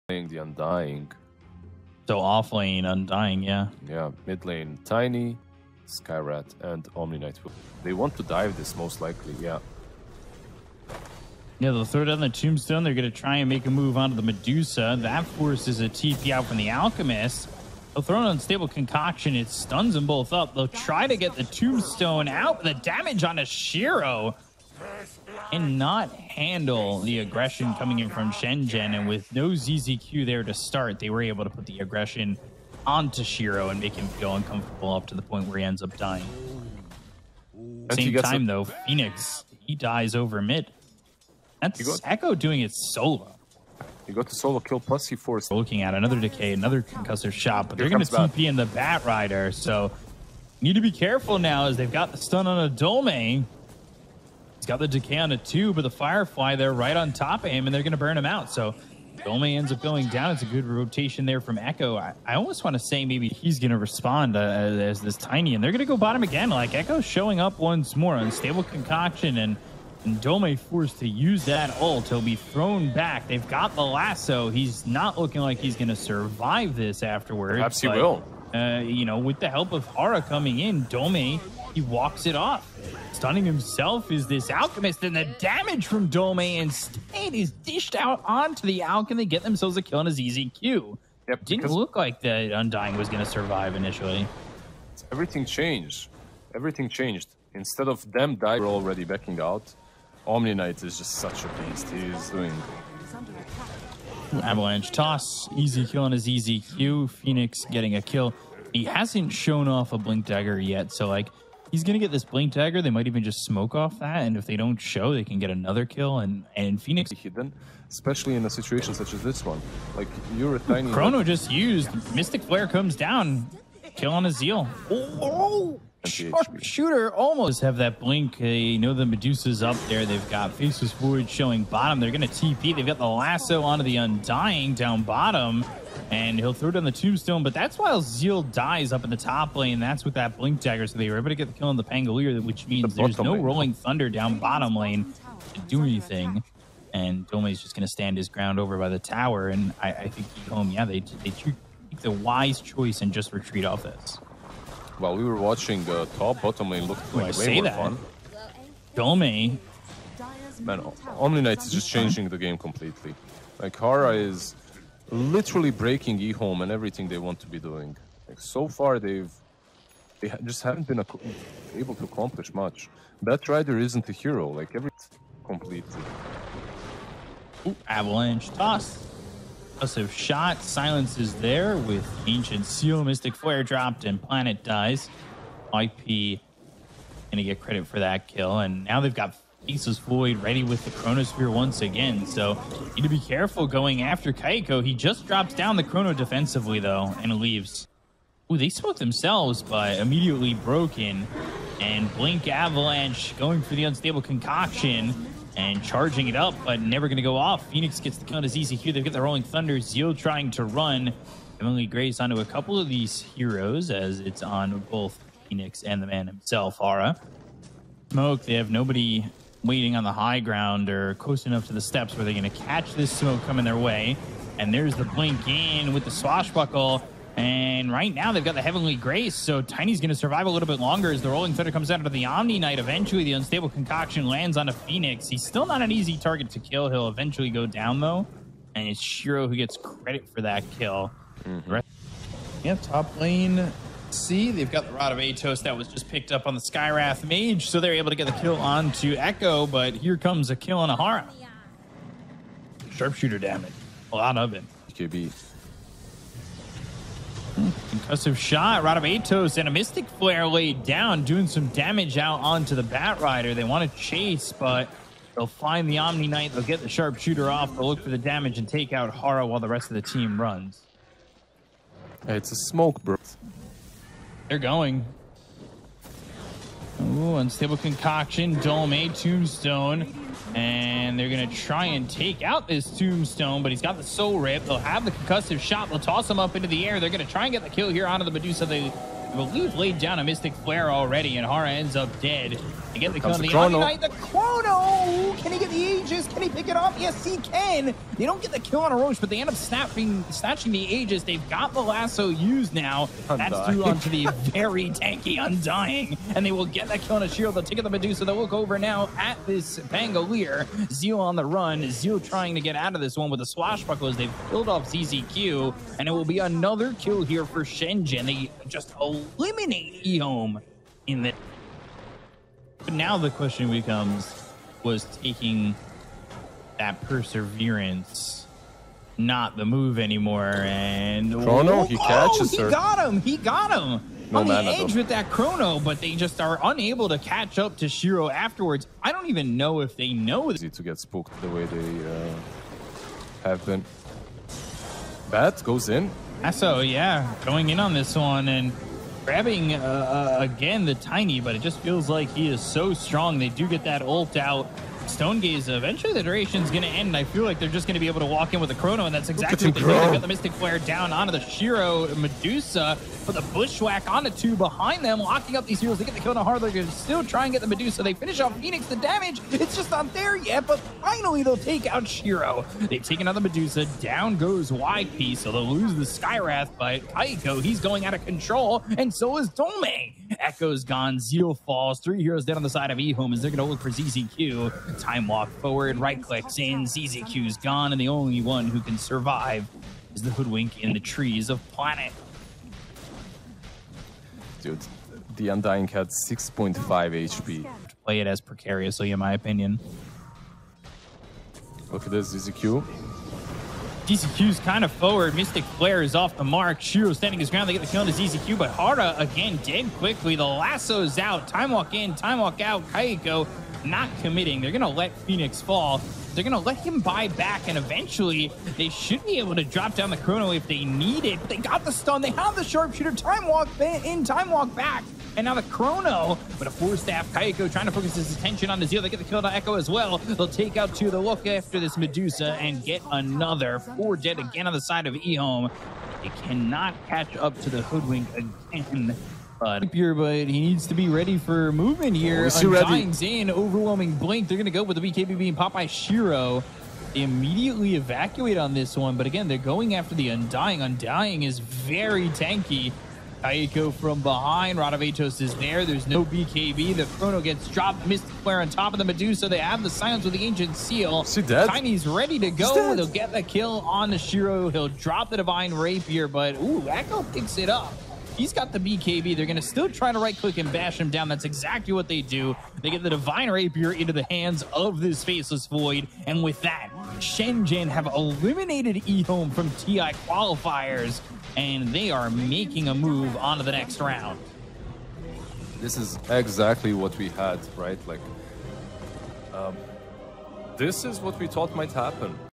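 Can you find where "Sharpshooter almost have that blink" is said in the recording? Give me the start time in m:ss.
2:06.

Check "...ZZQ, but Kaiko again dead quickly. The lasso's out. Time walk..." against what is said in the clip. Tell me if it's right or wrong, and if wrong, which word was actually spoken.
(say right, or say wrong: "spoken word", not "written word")
wrong: "Hara", not "Kaiko".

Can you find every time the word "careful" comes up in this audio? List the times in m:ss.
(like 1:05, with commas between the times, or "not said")
0:50, 3:13.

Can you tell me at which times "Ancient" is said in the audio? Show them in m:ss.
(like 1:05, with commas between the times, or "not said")
3:02, 7:40.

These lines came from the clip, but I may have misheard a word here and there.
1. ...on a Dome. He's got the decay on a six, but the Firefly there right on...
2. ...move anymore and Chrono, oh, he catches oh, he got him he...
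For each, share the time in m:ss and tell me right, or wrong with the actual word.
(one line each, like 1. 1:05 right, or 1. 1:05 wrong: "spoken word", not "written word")
1. 0:52 wrong: "two", not "six"
2. 5:29 right.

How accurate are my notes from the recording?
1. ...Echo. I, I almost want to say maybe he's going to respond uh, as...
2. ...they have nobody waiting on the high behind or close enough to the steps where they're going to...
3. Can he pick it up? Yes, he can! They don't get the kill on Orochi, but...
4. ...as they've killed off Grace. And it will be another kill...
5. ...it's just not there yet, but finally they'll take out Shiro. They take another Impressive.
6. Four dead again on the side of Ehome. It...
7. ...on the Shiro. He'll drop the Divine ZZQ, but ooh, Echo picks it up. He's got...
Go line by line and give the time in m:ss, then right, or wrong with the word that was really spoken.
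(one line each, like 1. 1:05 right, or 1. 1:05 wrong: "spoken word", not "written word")
1. 1:01 right
2. 3:38 wrong: "ground", not "behind"
3. 4:56 right
4. 5:14 wrong: "ZZQ", not "Grace"
5. 6:09 wrong: "Medusa", not "Impressive"
6. 7:13 right
7. 7:43 wrong: "Rapier", not "ZZQ".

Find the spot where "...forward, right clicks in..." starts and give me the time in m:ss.
6:25.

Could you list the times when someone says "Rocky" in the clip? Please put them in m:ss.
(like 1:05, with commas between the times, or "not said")
not said.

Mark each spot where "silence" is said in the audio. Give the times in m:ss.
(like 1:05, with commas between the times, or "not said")
3:00, 7:39.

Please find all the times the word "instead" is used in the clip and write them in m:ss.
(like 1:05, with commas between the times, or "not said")
1:26, 1:37.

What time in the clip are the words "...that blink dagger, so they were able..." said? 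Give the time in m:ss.
2:20.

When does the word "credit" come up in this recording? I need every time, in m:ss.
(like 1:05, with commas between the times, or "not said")
3:07, 3:59.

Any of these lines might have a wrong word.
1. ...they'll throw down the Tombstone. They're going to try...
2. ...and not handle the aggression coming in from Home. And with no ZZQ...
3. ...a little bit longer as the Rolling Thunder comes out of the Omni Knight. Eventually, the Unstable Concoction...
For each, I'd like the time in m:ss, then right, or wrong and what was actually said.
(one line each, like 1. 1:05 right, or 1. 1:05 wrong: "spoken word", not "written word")
1. 0:11 right
2. 0:25 wrong: "Shenzhen", not "Home"
3. 3:50 right.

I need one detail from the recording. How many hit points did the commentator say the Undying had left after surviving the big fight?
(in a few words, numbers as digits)
6.5.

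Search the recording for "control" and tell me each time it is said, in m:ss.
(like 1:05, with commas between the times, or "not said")
6:18.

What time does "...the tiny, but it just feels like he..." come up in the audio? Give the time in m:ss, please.
5:50.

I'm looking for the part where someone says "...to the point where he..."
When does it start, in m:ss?
0:35.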